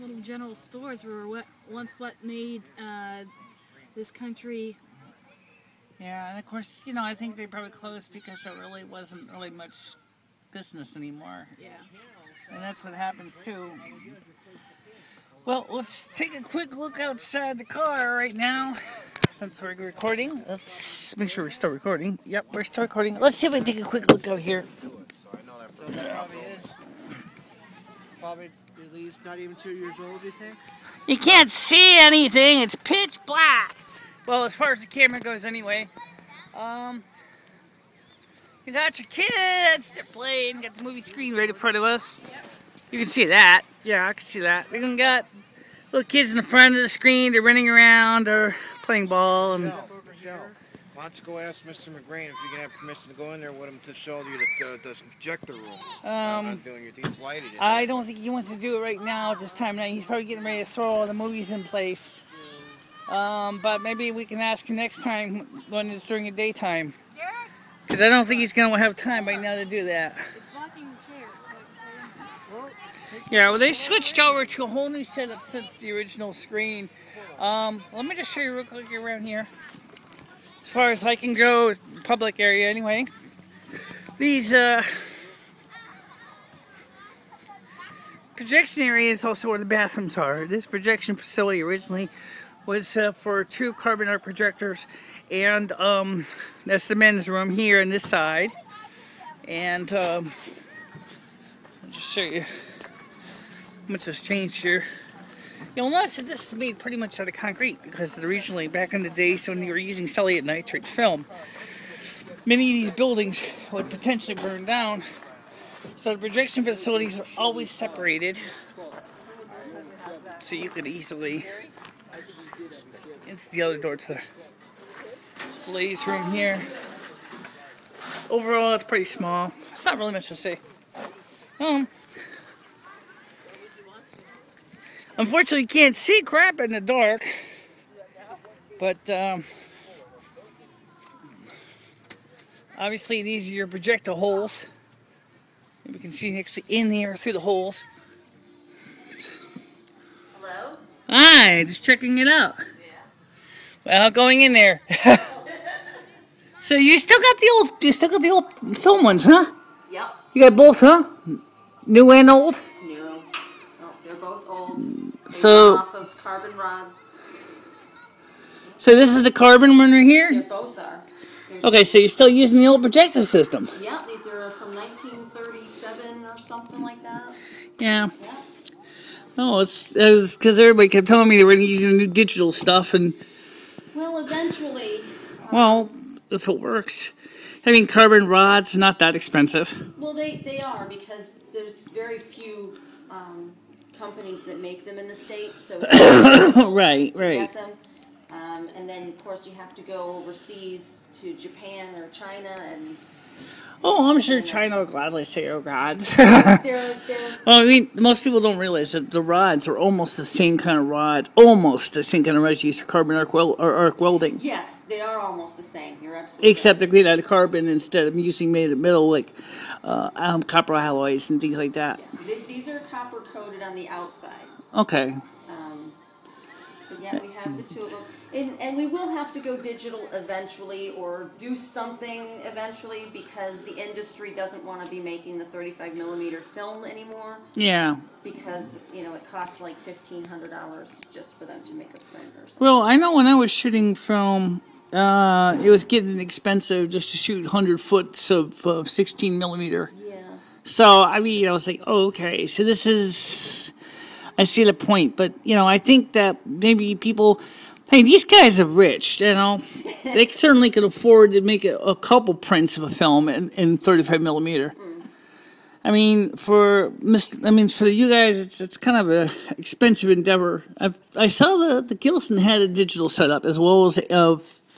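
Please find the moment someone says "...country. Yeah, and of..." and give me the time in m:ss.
0:04.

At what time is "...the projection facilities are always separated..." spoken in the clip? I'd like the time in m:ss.
1:56.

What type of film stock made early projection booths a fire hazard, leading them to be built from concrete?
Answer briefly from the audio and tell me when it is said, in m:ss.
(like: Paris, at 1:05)
celluloid nitrate, at 1:50.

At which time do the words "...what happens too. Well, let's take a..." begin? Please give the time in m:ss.
0:12.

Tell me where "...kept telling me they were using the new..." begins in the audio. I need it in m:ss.
3:00.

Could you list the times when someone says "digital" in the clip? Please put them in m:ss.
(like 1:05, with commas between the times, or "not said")
3:02, 3:49, 4:32.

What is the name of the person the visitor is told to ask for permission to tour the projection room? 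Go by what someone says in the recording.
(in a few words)
Mr. McGrain.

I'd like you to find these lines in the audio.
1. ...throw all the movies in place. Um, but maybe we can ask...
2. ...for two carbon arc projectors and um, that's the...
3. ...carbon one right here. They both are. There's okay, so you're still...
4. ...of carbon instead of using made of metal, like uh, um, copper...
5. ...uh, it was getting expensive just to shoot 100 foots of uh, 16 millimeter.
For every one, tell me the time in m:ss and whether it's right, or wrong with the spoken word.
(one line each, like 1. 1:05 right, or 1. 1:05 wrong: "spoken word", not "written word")
1. 1:00 right
2. 1:33 right
3. 2:49 right
4. 3:37 right
5. 4:04 right.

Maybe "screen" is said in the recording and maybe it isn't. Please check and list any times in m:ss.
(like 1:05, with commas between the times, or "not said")
0:41, 0:46, 1:16.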